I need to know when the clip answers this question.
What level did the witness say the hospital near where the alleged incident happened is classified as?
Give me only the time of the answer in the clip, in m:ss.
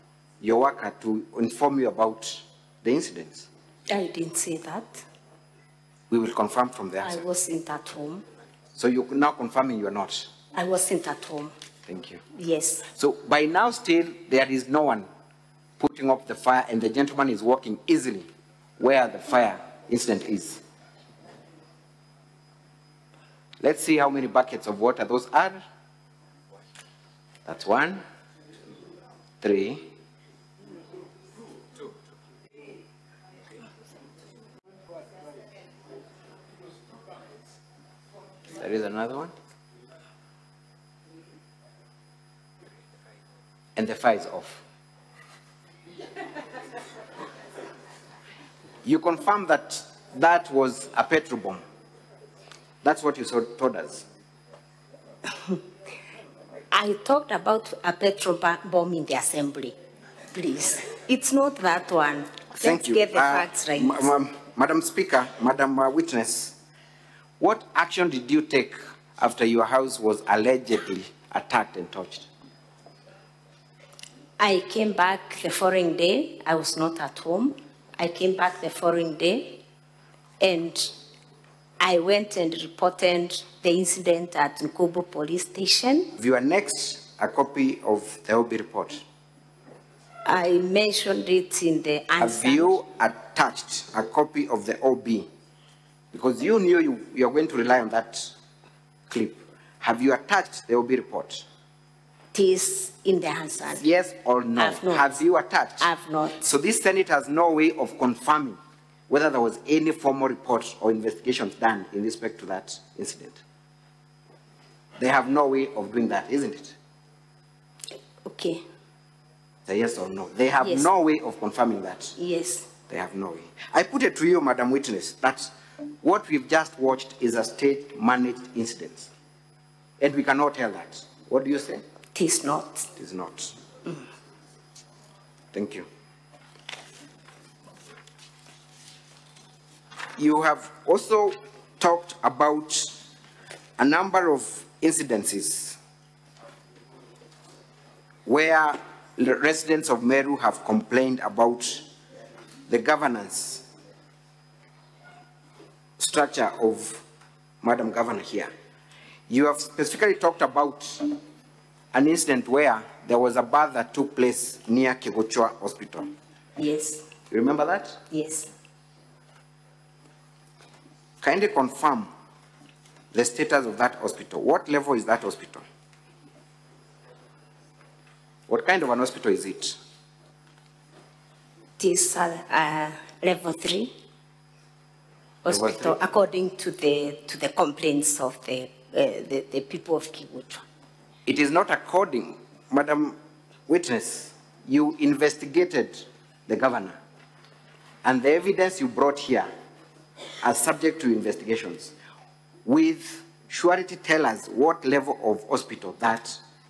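3:03.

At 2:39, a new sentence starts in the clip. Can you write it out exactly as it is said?
You have specifically talked about an incident where there was a bath that took place near Kigochua Hospital.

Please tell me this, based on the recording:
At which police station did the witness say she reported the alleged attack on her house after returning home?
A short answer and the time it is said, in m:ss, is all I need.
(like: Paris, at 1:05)
Nkubu police station, at 1:24.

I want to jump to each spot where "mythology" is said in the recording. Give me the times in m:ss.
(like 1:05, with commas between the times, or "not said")
not said.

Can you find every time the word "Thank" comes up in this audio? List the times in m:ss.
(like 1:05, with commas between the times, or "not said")
0:11, 1:02, 2:15.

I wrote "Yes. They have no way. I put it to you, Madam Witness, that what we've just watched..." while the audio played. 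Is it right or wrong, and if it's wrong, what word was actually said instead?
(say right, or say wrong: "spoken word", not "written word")
right.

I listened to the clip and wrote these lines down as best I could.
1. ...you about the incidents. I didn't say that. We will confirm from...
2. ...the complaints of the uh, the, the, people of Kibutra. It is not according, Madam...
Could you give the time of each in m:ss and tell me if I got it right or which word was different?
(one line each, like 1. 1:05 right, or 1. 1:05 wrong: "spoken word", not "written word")
1. 0:01 right
2. 3:07 right.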